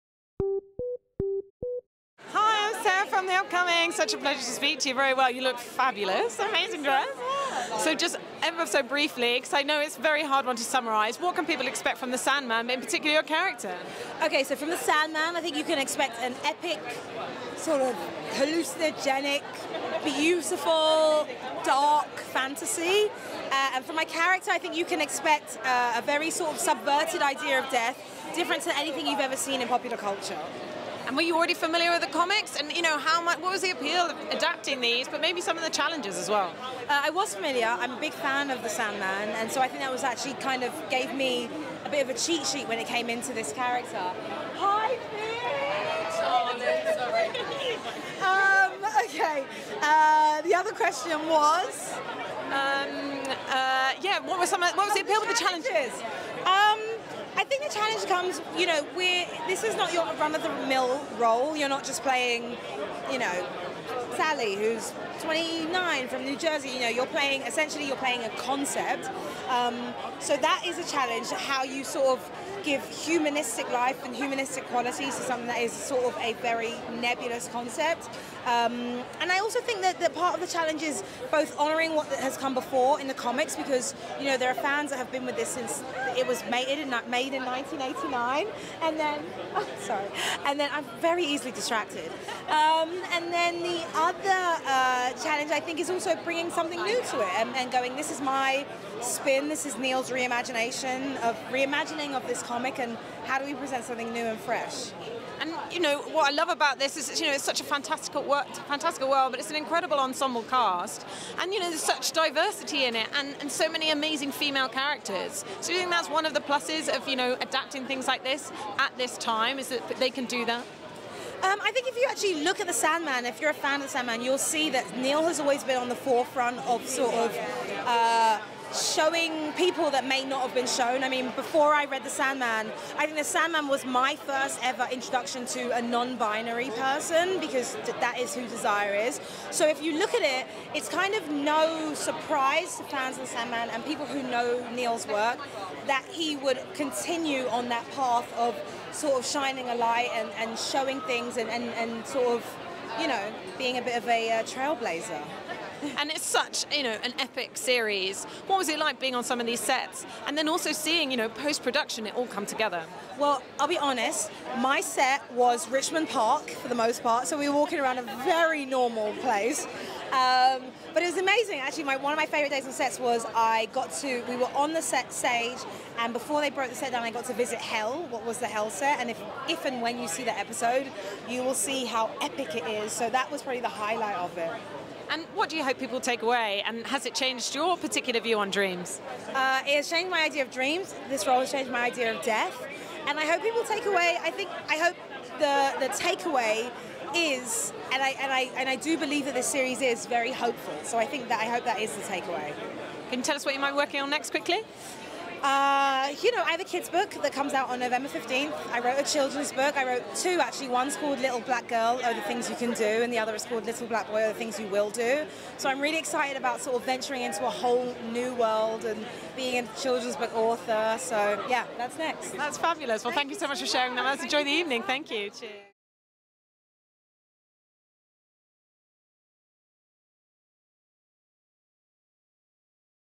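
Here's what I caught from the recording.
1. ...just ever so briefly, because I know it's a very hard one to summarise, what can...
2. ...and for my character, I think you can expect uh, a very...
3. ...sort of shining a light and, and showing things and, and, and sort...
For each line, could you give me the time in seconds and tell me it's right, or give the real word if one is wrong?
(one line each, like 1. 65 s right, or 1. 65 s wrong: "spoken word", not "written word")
1. 7 s right
2. 23 s right
3. 148 s right.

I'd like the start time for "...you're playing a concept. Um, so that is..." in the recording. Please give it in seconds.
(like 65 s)
67 s.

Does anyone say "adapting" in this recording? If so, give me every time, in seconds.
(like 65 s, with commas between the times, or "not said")
34 s, 117 s.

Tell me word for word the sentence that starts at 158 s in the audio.
What was it like being on some of these sets, and then also seeing you know post production it all come together?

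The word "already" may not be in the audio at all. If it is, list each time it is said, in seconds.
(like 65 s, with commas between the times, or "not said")
31 s.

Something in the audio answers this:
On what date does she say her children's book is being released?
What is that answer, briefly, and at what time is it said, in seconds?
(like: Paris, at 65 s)
November 15th, at 207 s.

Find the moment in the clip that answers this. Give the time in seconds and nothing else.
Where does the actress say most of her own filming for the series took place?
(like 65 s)
165 s.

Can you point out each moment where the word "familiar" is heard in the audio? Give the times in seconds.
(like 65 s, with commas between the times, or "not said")
31 s, 37 s.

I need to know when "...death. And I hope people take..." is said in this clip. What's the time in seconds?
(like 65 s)
192 s.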